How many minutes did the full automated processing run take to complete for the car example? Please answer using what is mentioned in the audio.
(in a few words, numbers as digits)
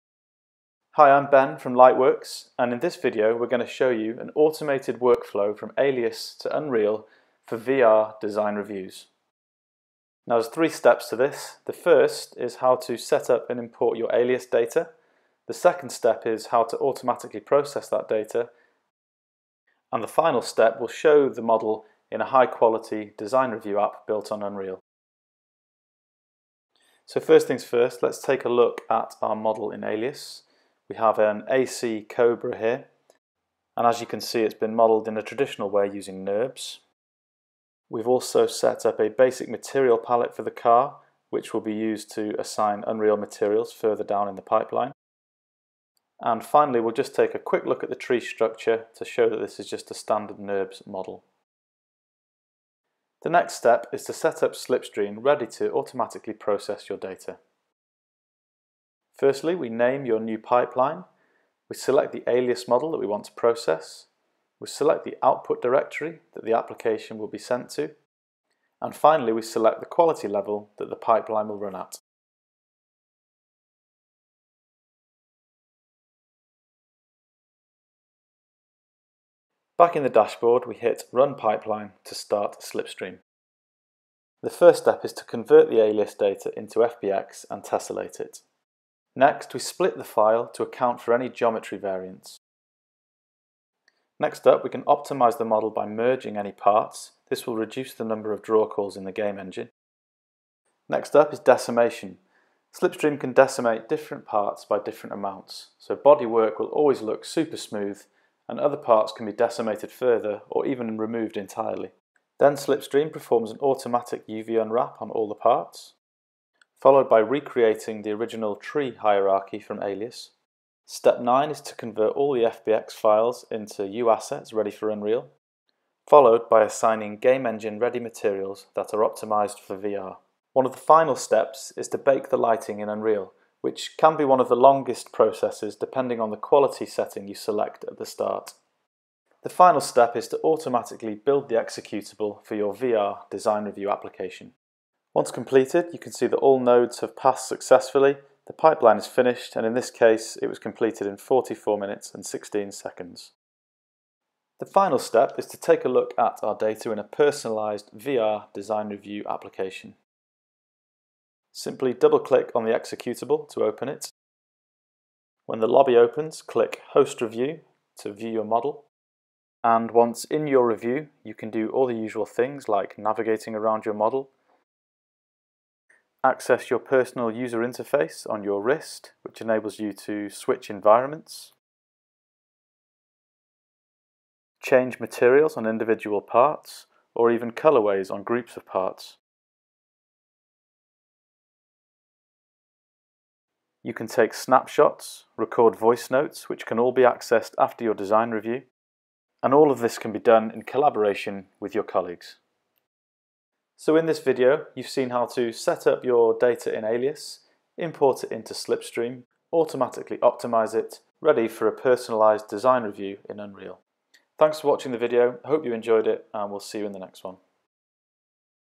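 44 minutes.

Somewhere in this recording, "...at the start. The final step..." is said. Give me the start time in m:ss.
2:17.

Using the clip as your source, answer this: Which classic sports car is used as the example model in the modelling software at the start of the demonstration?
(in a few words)
AC Cobra.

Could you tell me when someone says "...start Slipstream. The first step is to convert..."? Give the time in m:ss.
1:22.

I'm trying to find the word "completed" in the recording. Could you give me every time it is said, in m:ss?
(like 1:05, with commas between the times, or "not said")
2:25, 2:30.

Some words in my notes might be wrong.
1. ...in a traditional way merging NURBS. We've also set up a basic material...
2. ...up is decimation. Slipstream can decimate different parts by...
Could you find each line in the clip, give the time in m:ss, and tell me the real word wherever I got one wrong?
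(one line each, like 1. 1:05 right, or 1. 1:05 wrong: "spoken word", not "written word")
1. 0:35 wrong: "using", not "merging"
2. 1:41 right.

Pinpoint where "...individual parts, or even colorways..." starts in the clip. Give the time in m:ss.
3:05.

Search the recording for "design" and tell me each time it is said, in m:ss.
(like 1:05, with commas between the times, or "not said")
0:08, 0:23, 2:23, 2:38, 3:17, 3:32.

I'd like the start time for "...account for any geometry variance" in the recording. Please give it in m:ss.
1:30.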